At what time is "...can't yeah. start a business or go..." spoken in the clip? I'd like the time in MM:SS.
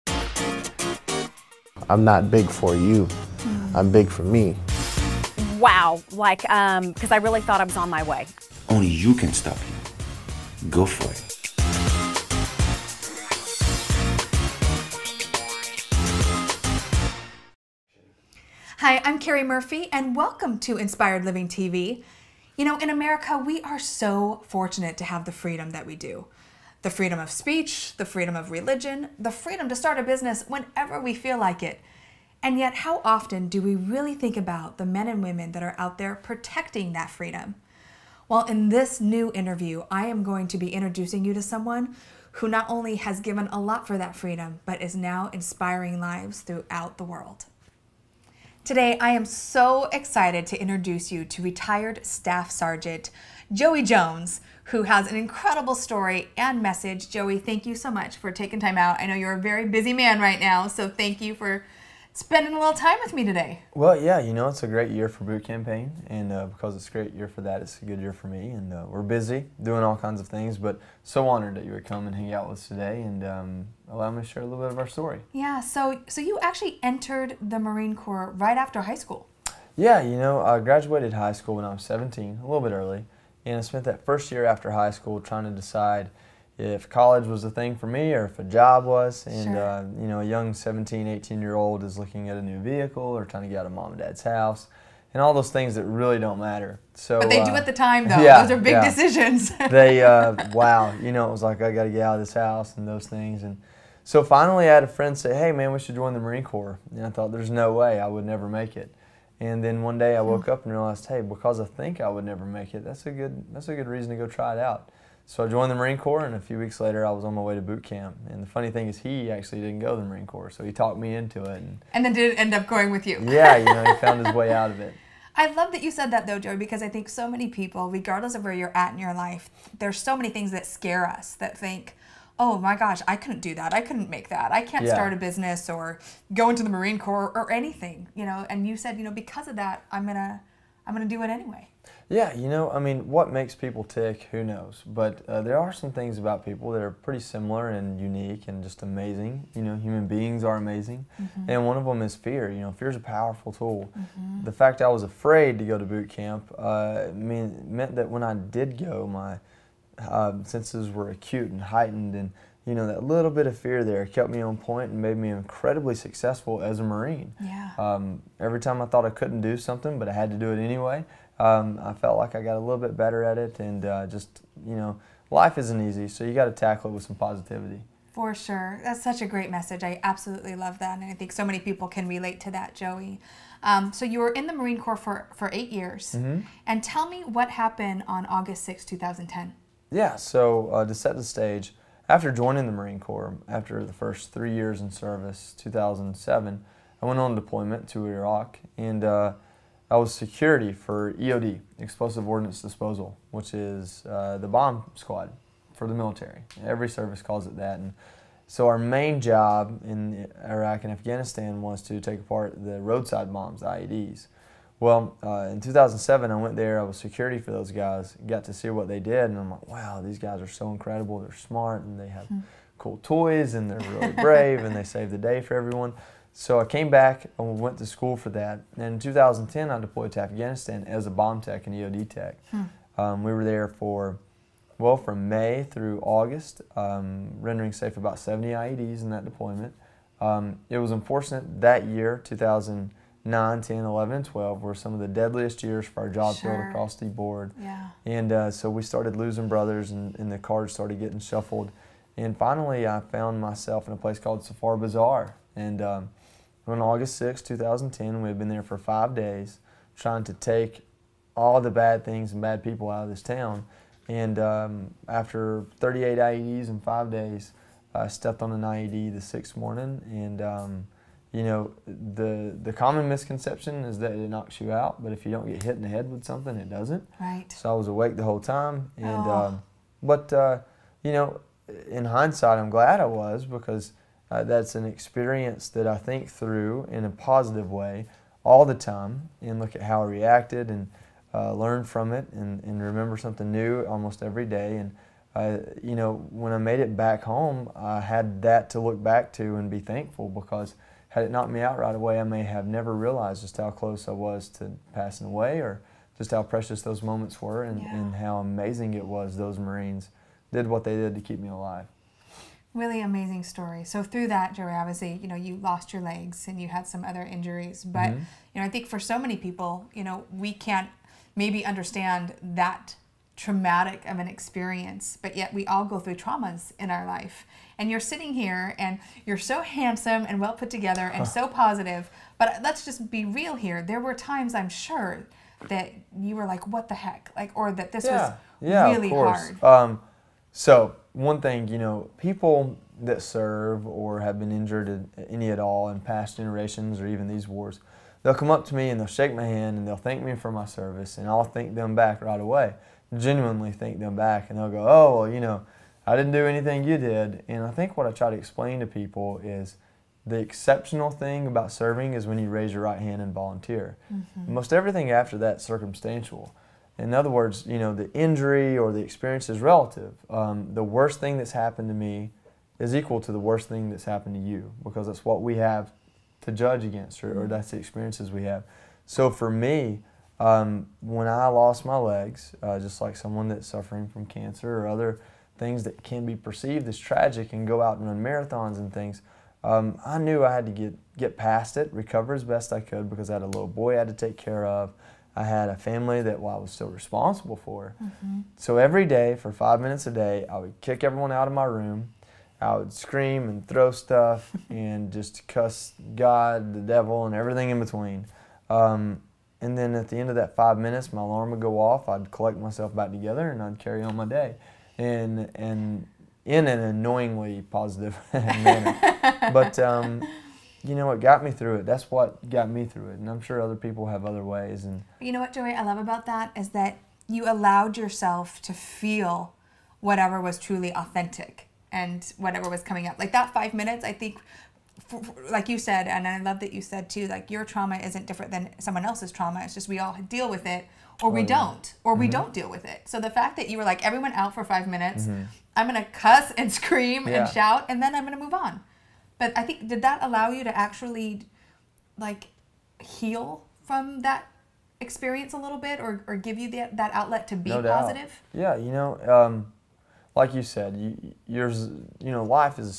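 02:14.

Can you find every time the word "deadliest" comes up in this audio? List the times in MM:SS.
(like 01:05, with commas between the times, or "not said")
04:05.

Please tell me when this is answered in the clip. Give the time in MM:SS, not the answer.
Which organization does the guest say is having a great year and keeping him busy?
01:05.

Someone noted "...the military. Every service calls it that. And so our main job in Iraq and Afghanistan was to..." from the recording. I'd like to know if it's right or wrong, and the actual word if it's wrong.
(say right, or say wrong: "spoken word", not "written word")
right.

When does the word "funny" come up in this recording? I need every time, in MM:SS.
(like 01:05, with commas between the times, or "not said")
01:58.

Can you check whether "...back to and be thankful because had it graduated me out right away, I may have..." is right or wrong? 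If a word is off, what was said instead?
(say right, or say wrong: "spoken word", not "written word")
wrong: "knocked", not "graduated".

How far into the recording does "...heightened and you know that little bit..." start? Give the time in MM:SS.
02:41.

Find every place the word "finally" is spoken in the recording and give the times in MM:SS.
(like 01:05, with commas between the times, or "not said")
01:44, 04:12.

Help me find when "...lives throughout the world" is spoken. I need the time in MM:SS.
00:45.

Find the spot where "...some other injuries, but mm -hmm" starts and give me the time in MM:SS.
05:16.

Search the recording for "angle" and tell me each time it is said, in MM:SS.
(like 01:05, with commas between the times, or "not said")
not said.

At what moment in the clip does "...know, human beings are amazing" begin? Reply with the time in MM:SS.
02:29.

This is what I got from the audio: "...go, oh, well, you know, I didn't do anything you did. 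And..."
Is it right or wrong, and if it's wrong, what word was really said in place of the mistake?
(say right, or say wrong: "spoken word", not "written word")
right.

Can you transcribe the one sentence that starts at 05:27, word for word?
And you're sitting here and you're so handsome and well put together and huh.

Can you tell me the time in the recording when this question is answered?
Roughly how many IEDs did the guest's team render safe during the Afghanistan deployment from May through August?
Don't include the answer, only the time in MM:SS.
03:57.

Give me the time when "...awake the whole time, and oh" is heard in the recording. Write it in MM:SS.
04:37.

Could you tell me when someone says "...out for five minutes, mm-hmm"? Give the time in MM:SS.
07:24.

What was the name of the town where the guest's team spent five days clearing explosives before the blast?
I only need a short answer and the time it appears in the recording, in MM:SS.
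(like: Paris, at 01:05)
Safar Bazaar, at 04:14.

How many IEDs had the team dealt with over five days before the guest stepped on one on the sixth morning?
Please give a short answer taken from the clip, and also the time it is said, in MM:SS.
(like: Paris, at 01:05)
38, at 04:25.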